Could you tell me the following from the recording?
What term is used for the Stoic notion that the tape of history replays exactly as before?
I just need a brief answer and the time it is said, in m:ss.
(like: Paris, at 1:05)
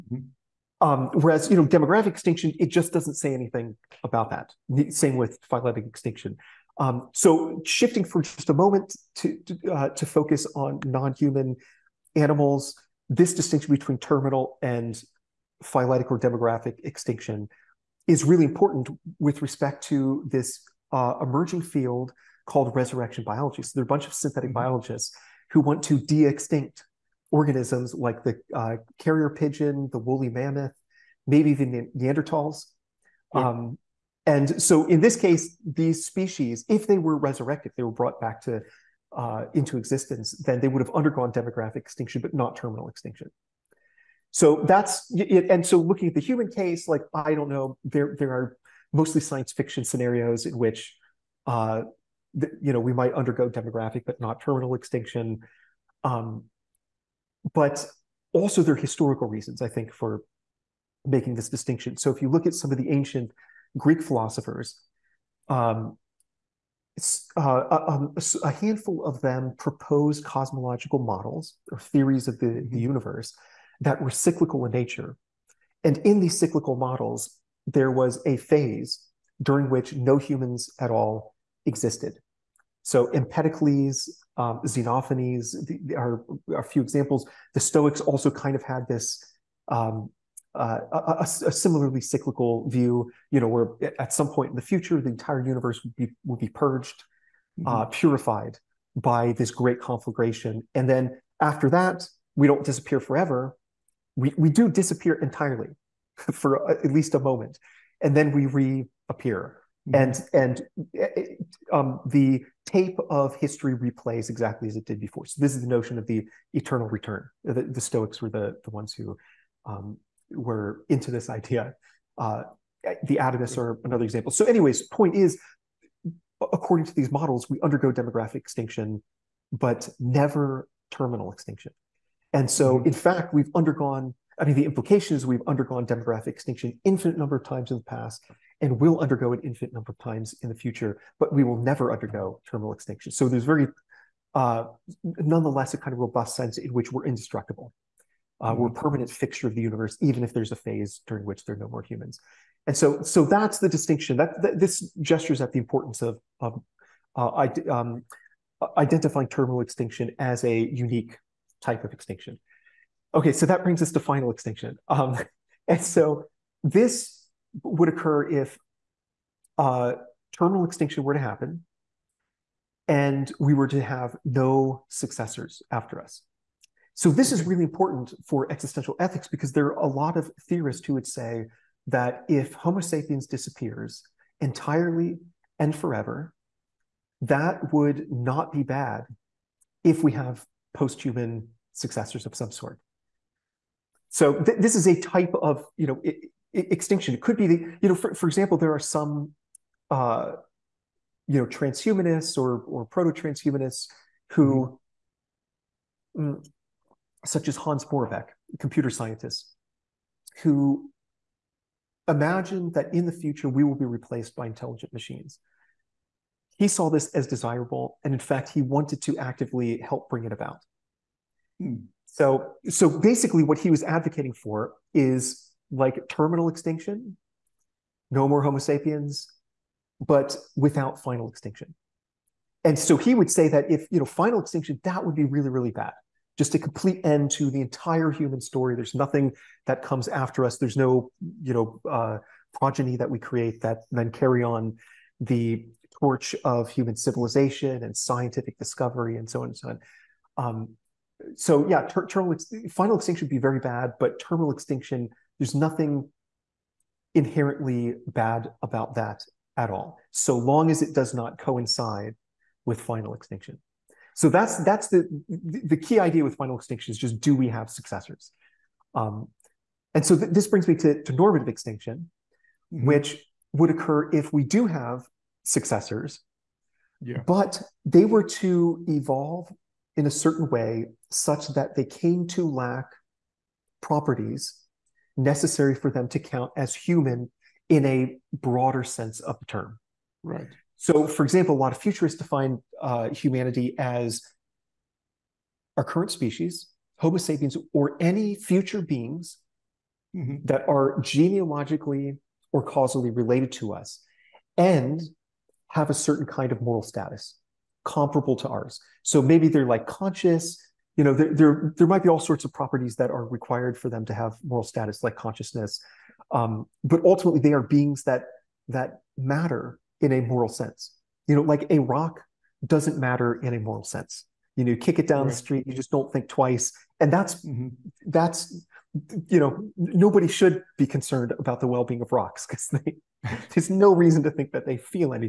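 The eternal return, at 1:56.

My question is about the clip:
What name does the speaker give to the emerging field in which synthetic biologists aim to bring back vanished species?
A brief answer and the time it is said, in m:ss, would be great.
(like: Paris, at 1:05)
Resurrection biology, at 0:22.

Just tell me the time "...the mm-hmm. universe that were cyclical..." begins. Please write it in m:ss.
1:12.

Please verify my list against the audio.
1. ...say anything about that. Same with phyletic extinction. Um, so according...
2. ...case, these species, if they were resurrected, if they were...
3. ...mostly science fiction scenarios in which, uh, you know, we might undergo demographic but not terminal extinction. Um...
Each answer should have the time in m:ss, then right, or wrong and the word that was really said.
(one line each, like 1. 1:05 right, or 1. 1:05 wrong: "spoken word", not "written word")
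1. 0:03 wrong: "shifting", not "according"
2. 0:35 right
3. 0:48 right.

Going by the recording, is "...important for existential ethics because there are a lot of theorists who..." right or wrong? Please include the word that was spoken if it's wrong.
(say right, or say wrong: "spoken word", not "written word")
right.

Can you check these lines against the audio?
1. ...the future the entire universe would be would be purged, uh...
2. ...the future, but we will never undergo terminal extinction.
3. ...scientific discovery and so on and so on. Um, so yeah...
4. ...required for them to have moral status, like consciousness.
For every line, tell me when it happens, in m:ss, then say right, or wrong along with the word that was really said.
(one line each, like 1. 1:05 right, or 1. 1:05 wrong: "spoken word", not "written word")
1. 1:34 right
2. 2:20 right
3. 4:07 right
4. 5:13 right.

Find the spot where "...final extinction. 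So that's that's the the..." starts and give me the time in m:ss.
4:22.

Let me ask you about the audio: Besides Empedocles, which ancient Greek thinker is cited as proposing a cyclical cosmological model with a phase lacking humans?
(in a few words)
Xenophanes.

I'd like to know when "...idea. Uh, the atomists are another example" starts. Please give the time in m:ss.
2:01.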